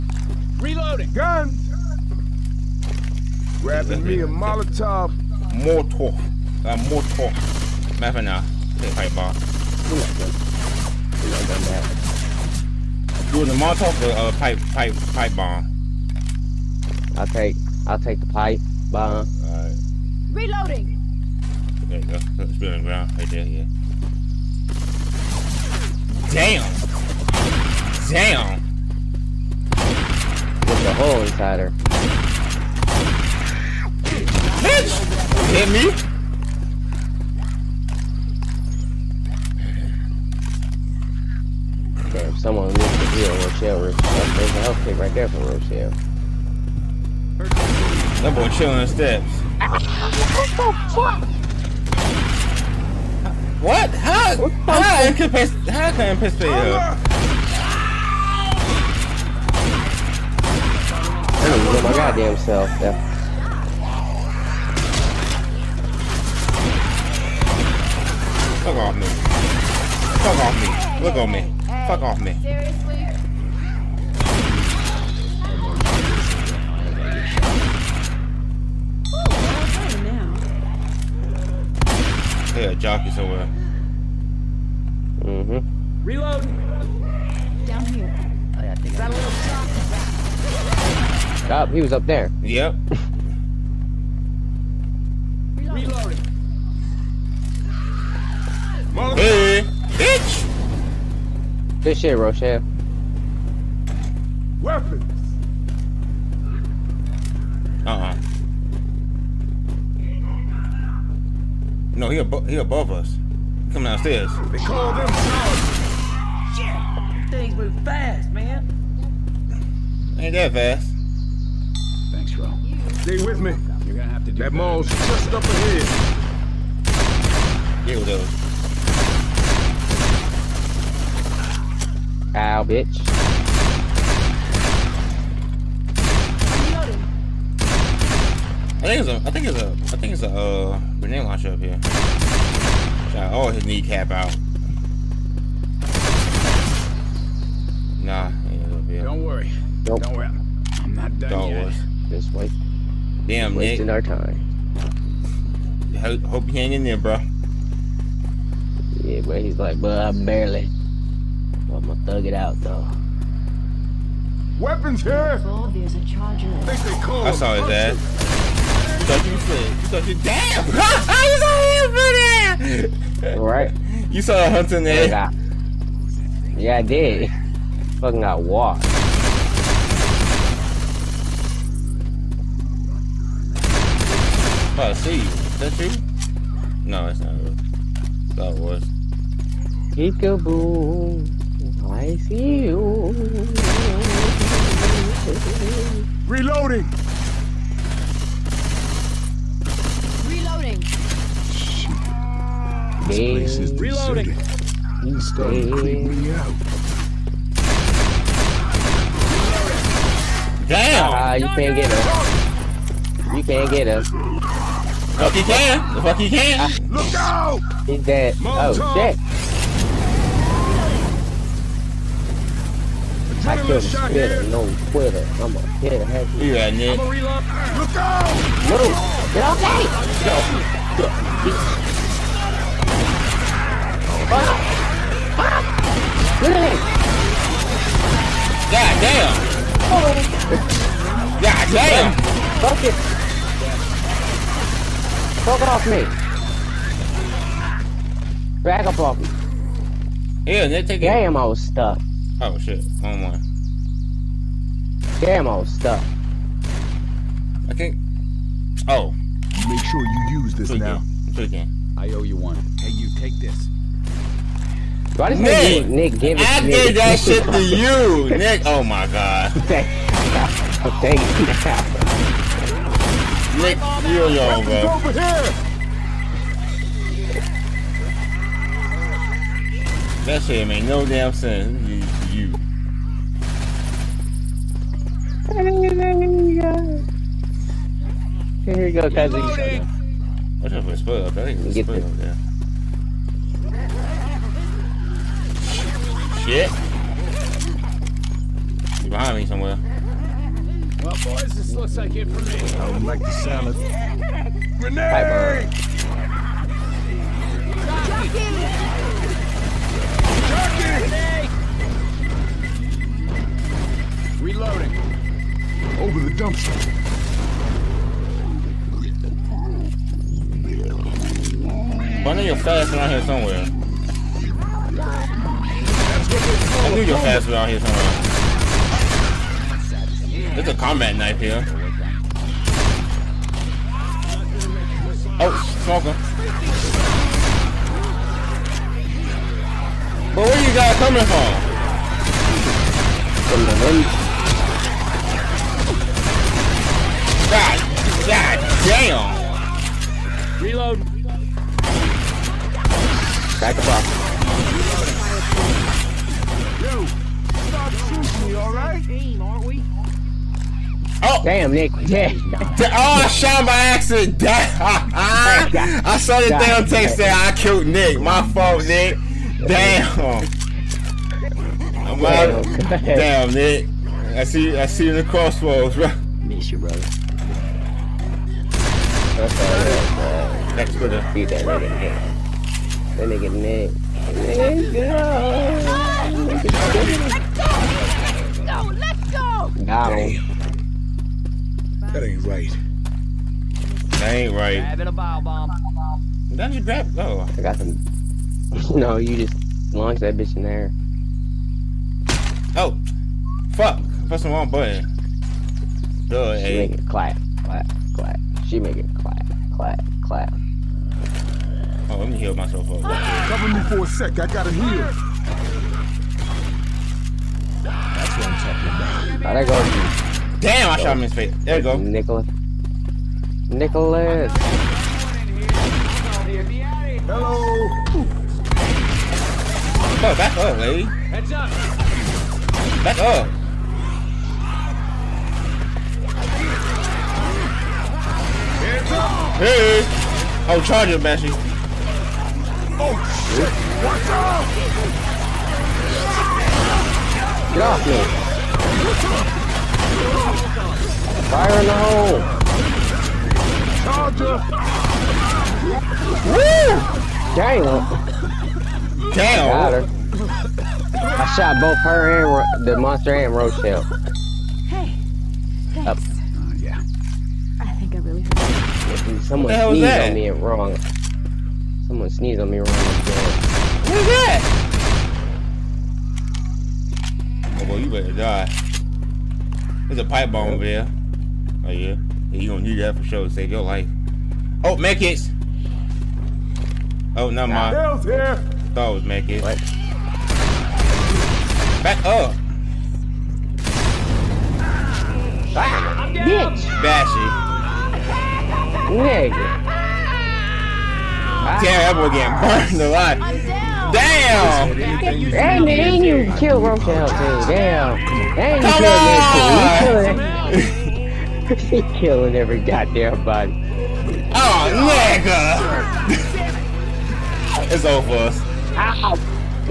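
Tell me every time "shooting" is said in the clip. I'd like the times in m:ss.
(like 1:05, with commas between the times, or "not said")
5:57.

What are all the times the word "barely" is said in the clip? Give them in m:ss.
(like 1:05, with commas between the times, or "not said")
2:40.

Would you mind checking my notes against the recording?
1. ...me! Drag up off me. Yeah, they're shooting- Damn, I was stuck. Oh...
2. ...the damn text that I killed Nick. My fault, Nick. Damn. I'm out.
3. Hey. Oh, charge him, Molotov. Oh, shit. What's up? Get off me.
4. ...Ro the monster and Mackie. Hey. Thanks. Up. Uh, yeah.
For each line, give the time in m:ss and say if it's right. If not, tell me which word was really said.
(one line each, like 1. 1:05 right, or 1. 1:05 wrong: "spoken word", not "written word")
1. 4:05 wrong: "taking", not "shooting"
2. 6:06 right
3. 7:19 wrong: "Bashy", not "Molotov"
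4. 7:42 wrong: "Rochelle", not "Mackie".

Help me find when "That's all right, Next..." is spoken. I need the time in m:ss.
6:19.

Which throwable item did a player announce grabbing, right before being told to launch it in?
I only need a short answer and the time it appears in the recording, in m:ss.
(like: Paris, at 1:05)
Bile bomb, at 6:35.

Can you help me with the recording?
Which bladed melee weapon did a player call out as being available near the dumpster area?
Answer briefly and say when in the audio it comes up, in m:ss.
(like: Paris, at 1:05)
Combat knife, at 5:30.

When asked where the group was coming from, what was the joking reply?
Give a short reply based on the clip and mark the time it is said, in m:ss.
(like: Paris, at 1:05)
From the hood, at 5:43.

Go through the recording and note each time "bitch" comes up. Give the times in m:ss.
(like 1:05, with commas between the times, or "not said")
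0:34, 1:39, 2:12, 6:40, 8:16.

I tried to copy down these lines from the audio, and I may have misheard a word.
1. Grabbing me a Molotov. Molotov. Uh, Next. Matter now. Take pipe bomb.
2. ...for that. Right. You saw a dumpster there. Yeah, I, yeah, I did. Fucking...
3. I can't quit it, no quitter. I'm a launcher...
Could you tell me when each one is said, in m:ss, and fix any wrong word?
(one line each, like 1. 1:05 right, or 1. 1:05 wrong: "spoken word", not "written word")
1. 0:03 wrong: "Molotov", not "Next"
2. 2:52 wrong: "hunter", not "dumpster"
3. 3:43 wrong: "hitter", not "launcher".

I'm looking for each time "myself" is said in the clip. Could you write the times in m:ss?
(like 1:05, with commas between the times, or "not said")
6:52.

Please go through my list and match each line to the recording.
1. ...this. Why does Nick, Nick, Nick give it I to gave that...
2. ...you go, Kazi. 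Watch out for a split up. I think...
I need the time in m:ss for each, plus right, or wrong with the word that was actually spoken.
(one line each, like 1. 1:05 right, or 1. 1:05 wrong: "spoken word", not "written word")
1. 4:23 right
2. 4:48 right.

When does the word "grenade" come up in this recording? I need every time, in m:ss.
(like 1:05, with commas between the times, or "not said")
2:20, 5:04.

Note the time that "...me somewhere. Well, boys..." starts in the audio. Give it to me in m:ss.
4:59.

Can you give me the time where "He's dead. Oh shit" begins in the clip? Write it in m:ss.
3:37.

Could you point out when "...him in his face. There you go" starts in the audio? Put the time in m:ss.
7:01.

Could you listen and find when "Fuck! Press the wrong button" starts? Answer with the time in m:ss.
6:43.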